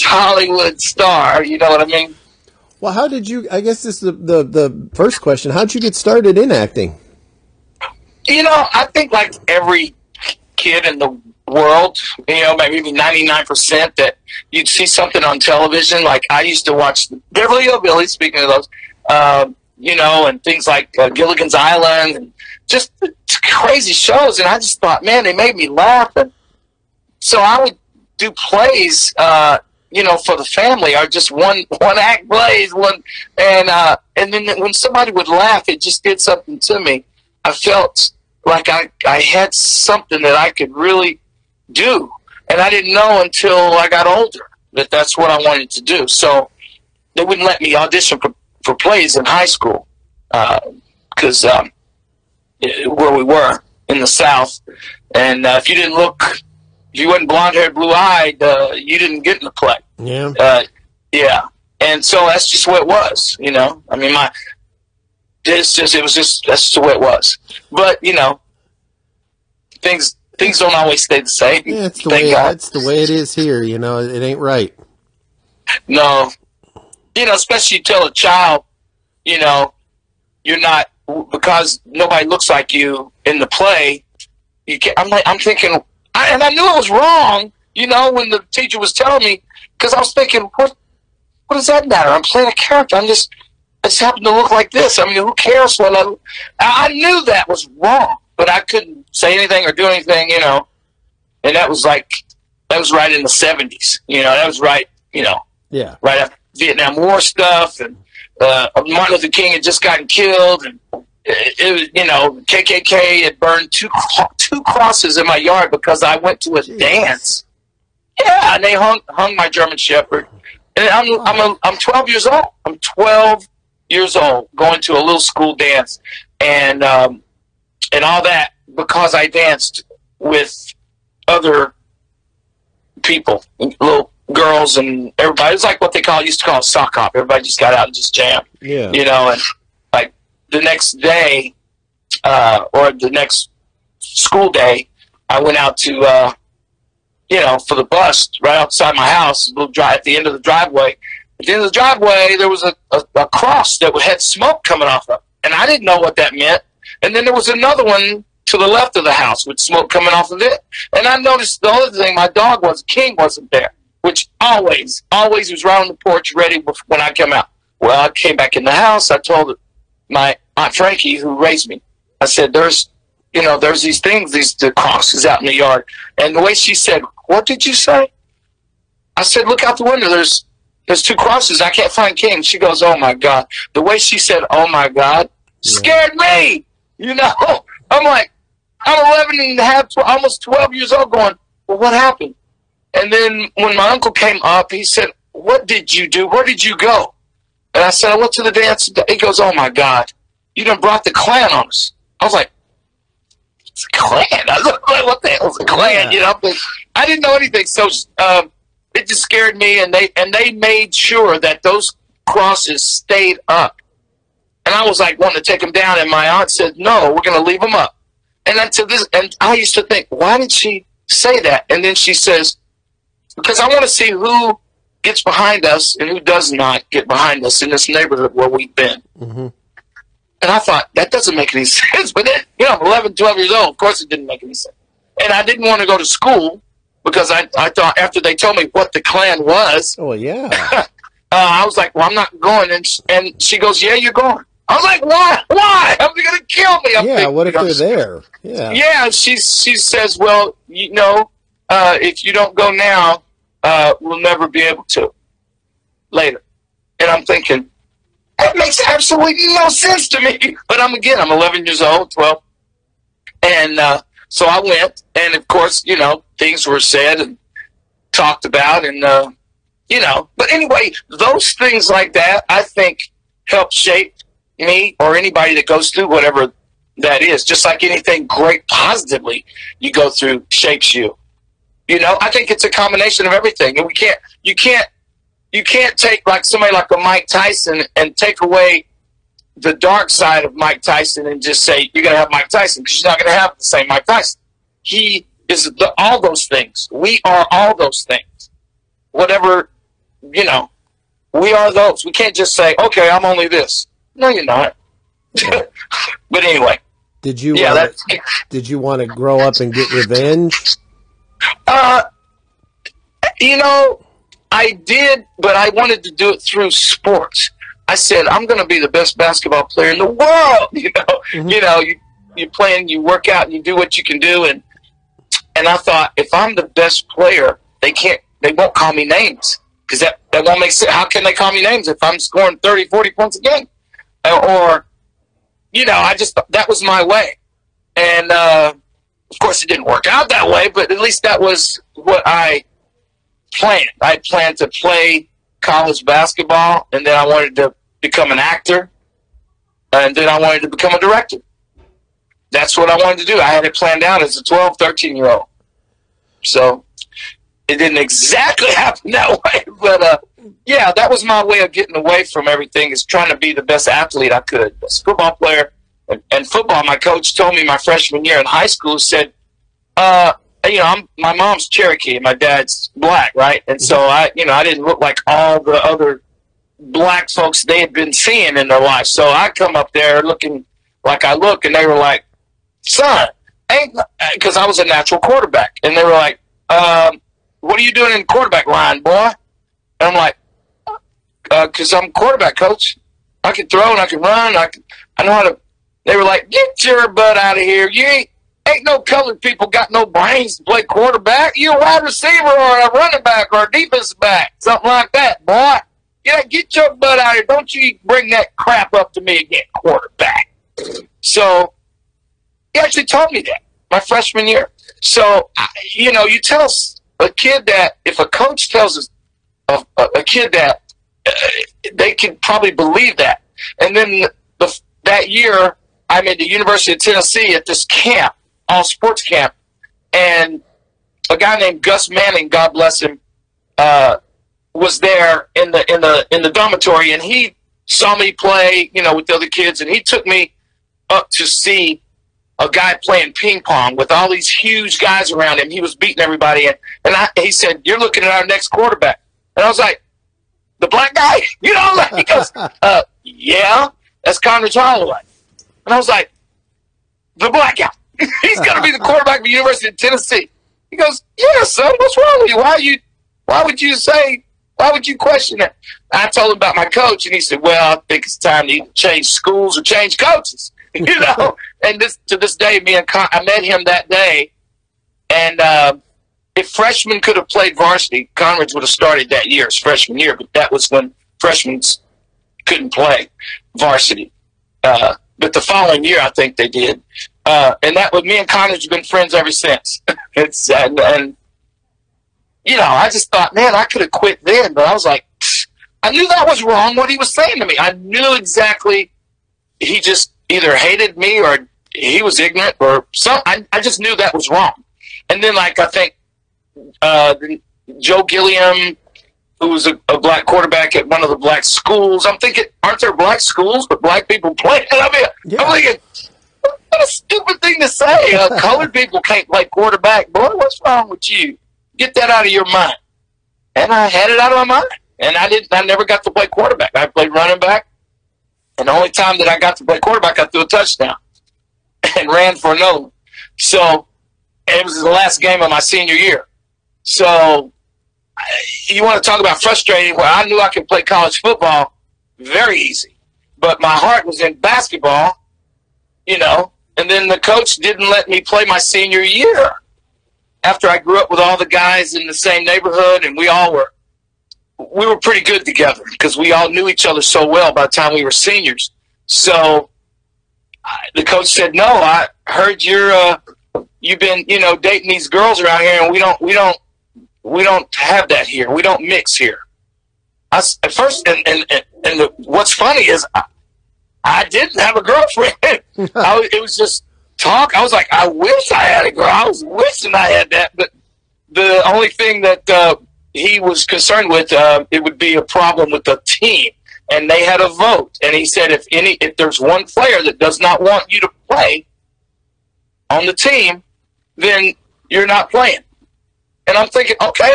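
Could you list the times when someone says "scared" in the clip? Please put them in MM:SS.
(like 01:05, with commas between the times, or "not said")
03:05, 03:29.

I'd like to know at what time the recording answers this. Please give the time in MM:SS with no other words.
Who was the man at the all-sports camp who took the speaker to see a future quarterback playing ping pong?
07:11.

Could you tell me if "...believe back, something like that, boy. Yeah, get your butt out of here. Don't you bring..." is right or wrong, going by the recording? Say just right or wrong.
wrong.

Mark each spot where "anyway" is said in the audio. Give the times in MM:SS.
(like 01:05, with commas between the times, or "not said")
04:30, 05:06.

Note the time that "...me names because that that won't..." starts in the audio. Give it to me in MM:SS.
05:28.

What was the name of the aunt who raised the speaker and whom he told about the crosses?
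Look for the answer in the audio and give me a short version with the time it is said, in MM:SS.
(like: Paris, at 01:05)
Frankie, at 02:50.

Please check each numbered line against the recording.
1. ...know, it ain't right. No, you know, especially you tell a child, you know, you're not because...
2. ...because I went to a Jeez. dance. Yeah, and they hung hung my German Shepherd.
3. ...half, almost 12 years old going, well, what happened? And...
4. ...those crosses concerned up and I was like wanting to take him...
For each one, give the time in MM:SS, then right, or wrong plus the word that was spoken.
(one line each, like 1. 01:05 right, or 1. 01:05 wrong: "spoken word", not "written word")
1. 01:13 right
2. 01:55 right
3. 03:09 right
4. 03:31 wrong: "stayed", not "concerned".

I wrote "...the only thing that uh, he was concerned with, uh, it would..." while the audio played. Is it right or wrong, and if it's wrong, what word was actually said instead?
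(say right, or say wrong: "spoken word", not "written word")
right.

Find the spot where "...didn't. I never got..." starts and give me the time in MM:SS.
08:45.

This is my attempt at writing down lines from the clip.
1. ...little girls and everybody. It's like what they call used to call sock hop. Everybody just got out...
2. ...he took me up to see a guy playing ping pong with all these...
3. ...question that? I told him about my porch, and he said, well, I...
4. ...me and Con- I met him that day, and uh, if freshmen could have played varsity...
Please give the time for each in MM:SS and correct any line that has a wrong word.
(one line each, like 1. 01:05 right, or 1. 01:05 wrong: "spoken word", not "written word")
1. 02:13 right
2. 07:19 right
3. 07:45 wrong: "coach", not "porch"
4. 07:52 right.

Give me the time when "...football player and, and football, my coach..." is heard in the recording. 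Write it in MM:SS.
06:05.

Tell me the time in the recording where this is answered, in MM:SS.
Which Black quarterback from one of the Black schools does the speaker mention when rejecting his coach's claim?
08:27.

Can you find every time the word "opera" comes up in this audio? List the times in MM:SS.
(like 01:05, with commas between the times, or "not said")
not said.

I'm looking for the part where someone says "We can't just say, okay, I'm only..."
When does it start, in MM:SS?
05:02.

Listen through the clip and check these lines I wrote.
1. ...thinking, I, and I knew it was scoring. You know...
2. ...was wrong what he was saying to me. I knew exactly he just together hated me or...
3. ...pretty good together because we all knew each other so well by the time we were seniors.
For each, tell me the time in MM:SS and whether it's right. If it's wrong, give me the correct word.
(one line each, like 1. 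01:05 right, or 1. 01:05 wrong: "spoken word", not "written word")
1. 01:25 wrong: "wrong", not "scoring"
2. 08:16 wrong: "either", not "together"
3. 09:15 right.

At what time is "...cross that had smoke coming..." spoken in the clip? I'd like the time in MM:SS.
02:33.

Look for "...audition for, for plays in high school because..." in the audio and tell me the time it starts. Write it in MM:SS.
00:47.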